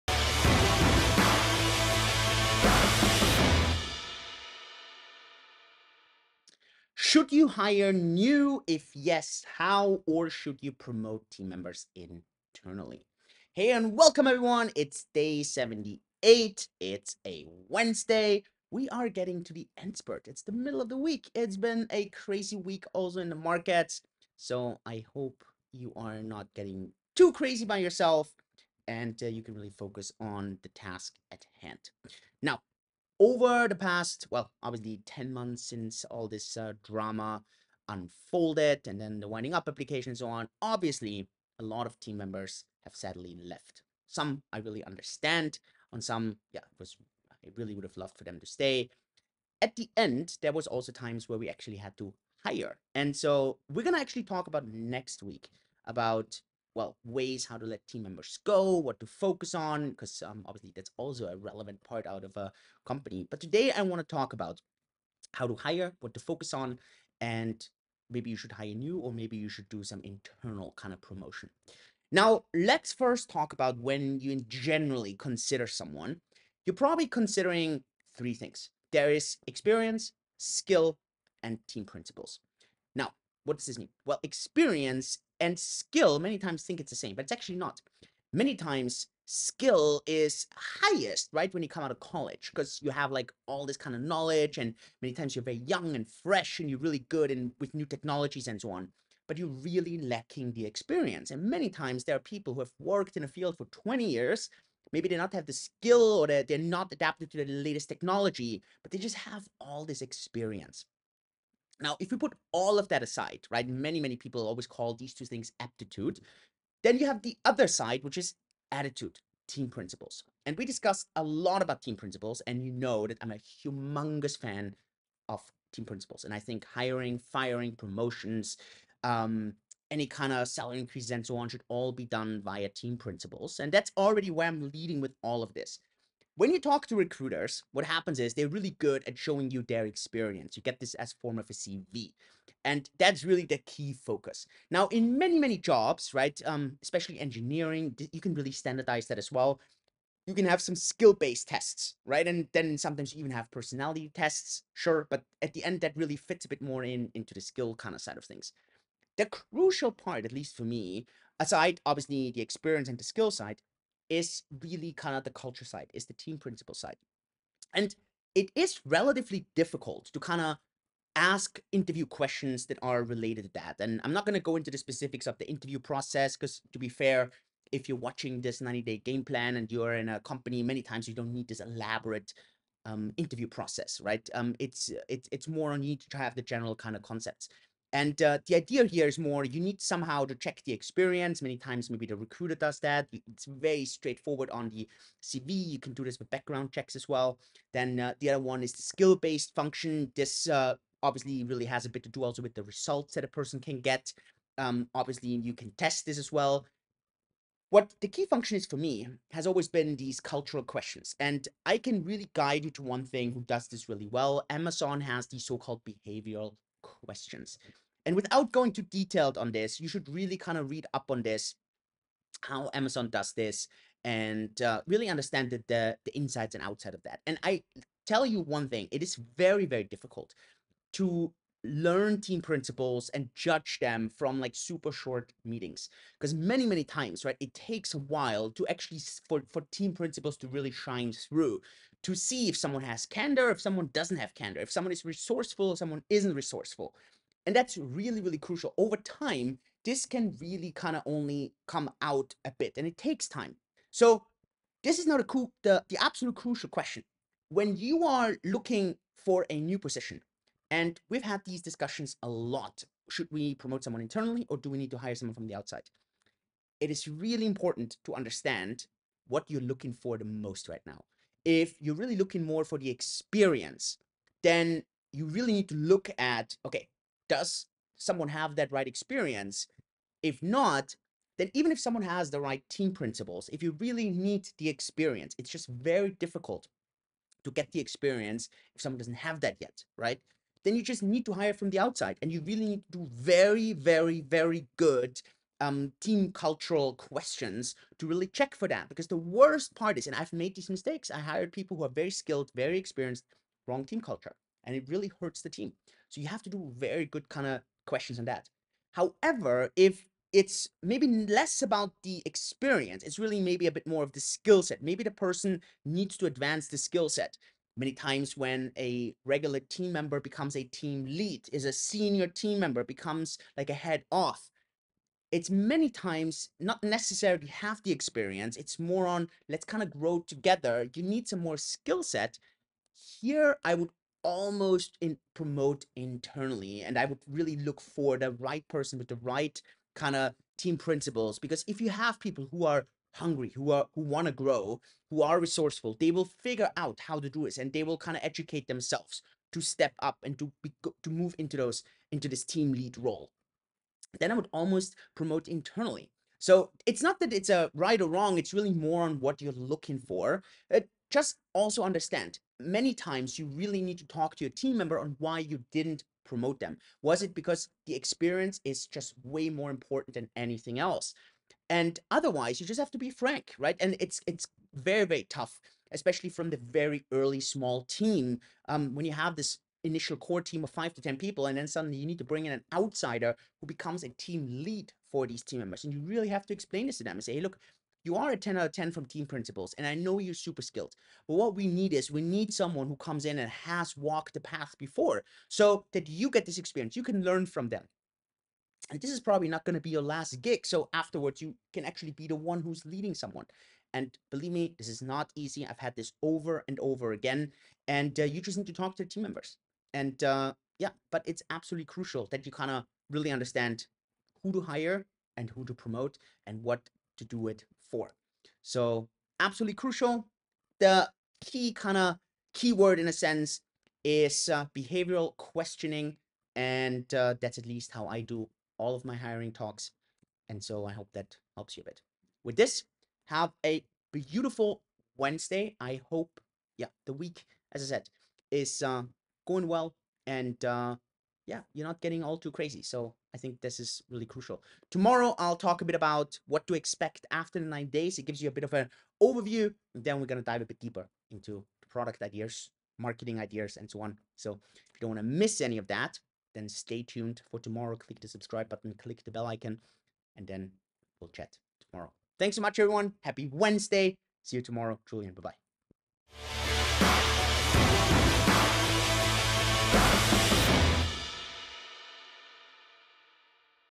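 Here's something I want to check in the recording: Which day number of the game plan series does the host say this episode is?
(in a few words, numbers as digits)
78.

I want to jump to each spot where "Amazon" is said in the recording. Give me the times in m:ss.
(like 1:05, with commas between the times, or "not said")
3:34, 3:42.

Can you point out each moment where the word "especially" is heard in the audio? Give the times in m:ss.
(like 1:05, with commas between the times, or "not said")
2:26, 6:15.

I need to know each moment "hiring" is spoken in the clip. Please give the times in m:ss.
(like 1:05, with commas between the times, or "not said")
2:06, 7:09.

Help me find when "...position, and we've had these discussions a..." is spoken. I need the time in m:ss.
4:19.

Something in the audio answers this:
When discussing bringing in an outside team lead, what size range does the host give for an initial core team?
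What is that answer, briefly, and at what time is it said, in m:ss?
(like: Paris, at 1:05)
5 to 10 people, at 6:20.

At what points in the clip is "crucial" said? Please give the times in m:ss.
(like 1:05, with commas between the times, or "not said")
2:39, 4:08, 4:16, 6:51, 6:59, 7:24.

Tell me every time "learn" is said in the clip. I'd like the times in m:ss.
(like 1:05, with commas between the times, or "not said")
3:51, 6:37.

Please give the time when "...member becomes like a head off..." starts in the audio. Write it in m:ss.
5:22.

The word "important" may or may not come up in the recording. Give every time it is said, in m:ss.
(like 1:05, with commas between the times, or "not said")
4:27, 6:09.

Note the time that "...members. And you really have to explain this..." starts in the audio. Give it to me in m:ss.
6:25.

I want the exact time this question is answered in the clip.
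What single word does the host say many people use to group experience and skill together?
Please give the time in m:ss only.
1:55.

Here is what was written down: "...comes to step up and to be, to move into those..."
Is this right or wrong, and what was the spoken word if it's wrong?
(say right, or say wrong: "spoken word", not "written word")
wrong: "themselves", not "comes".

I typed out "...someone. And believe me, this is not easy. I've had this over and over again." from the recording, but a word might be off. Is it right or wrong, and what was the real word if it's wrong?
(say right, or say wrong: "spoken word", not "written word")
right.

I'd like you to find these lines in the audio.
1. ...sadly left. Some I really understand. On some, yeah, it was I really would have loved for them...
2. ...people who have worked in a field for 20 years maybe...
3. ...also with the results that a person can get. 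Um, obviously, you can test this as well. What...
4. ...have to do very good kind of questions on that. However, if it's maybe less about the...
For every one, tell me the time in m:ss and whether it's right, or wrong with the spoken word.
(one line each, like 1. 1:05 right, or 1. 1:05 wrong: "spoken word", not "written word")
1. 0:42 right
2. 1:42 right
3. 3:22 right
4. 5:06 right.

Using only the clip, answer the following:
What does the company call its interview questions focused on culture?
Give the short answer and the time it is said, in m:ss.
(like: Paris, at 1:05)
behavioral questions, at 3:35.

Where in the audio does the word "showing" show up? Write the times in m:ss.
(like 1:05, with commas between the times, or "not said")
2:19.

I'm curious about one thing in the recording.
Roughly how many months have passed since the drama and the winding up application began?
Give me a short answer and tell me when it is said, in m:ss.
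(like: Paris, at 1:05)
10 months, at 0:35.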